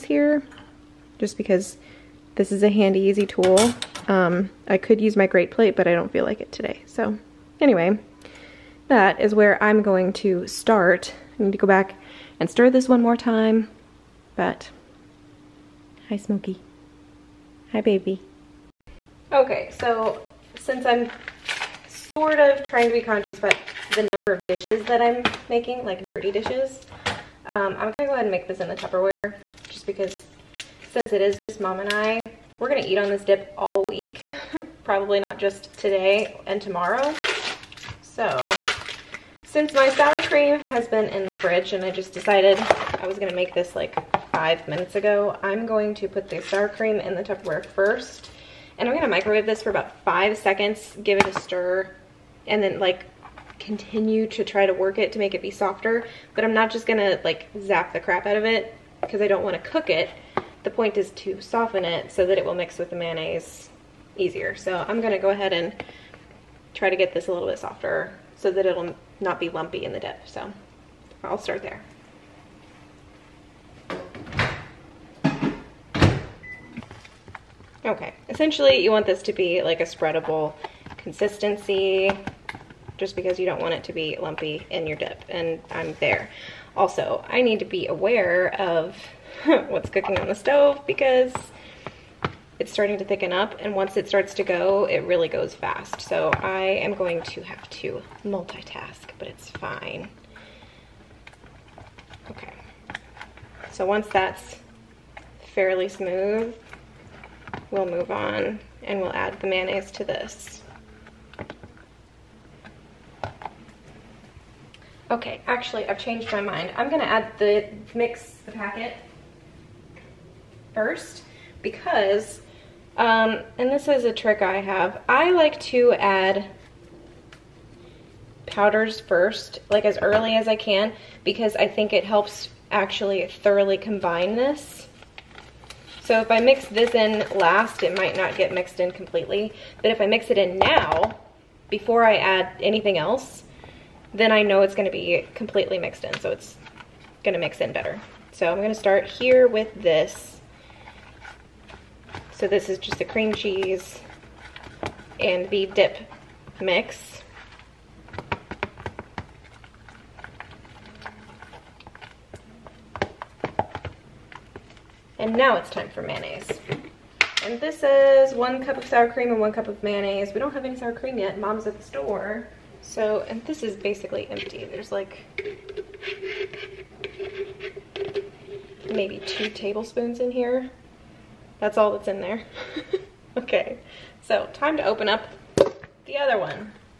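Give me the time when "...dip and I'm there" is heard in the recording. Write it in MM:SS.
01:24.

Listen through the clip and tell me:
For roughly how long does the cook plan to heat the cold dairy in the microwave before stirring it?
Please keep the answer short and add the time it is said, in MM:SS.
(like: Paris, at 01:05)
5 seconds, at 00:50.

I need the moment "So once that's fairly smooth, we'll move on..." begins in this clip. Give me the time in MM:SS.
01:43.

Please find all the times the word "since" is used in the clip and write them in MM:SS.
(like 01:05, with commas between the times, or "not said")
00:20, 00:30, 00:39.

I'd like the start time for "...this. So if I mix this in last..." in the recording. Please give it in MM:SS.
02:14.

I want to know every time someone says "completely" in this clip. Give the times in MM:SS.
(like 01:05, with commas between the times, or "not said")
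02:18, 02:25.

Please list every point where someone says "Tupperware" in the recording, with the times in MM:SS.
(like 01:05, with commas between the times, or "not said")
00:28, 00:47.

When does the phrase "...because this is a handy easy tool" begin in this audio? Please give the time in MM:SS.
00:01.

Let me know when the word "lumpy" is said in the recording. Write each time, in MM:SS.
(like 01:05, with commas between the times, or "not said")
01:09, 01:24.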